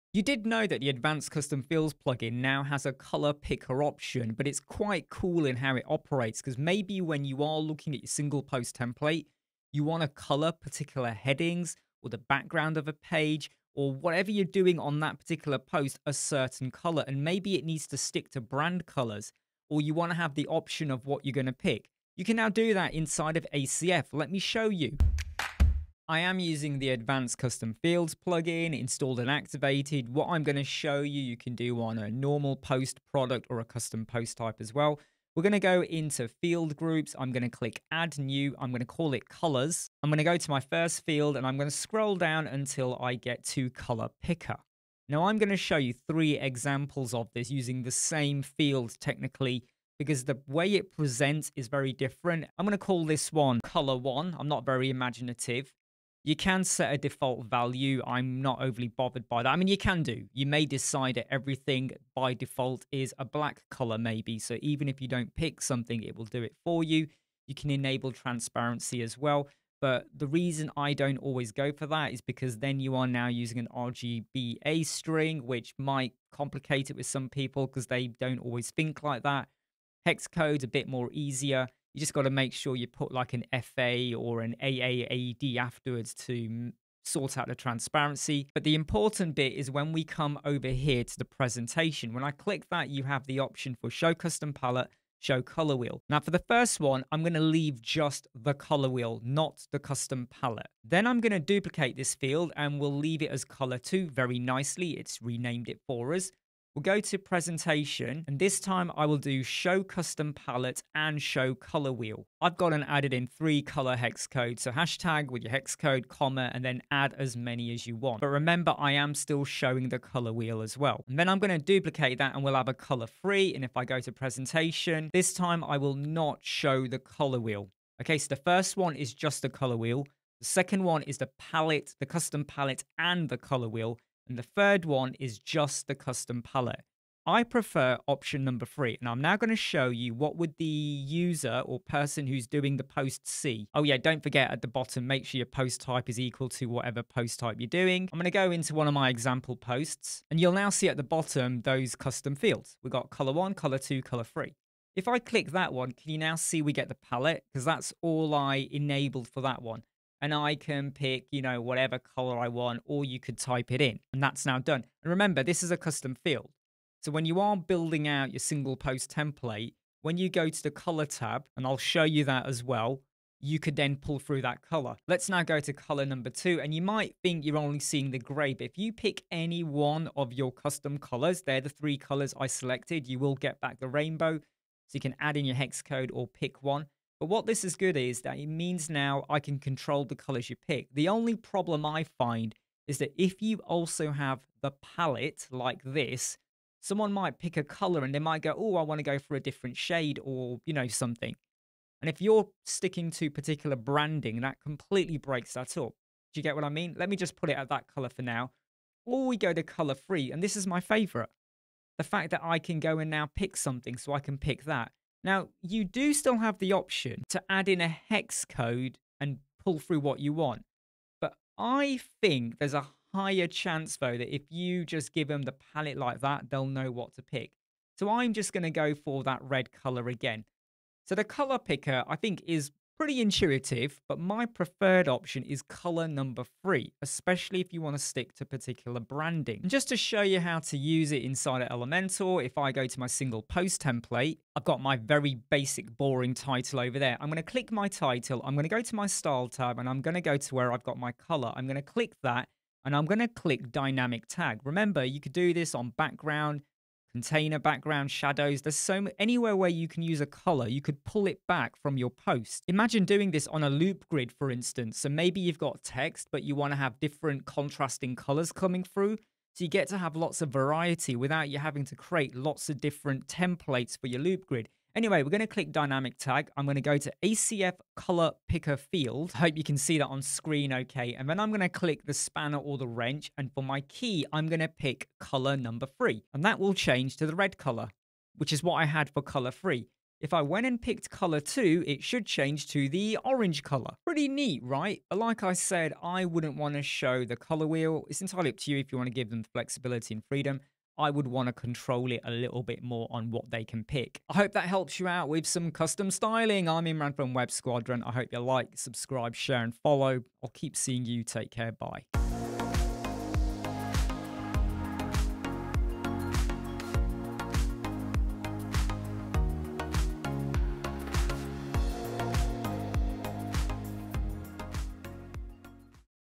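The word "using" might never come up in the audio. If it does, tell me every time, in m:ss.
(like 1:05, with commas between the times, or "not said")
0:26, 0:47, 1:13.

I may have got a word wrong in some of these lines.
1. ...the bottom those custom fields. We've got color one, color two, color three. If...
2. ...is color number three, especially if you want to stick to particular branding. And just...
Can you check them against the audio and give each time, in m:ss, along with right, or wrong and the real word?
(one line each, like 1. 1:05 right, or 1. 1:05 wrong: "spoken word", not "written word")
1. 2:30 right
2. 3:55 right.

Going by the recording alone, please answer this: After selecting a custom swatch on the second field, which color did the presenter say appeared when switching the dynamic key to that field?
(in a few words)
orange.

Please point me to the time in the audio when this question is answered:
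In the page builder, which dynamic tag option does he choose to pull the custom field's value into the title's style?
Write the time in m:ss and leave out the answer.
4:37.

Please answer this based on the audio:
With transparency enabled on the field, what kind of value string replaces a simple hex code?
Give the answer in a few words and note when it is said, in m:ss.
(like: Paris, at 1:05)
RGBA string, at 1:13.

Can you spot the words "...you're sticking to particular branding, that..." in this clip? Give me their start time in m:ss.
3:22.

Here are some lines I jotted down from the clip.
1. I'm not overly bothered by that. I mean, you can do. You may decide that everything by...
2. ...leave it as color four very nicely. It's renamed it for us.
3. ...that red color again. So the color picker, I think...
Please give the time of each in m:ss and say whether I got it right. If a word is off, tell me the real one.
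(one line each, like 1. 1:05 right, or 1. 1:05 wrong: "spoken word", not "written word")
1. 0:58 right
2. 1:42 wrong: "two", not "four"
3. 3:49 right.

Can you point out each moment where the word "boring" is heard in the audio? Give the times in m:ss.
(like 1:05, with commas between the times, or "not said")
4:05.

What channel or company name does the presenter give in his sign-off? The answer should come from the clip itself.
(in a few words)
Web Squadron.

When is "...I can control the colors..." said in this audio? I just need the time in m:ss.
3:09.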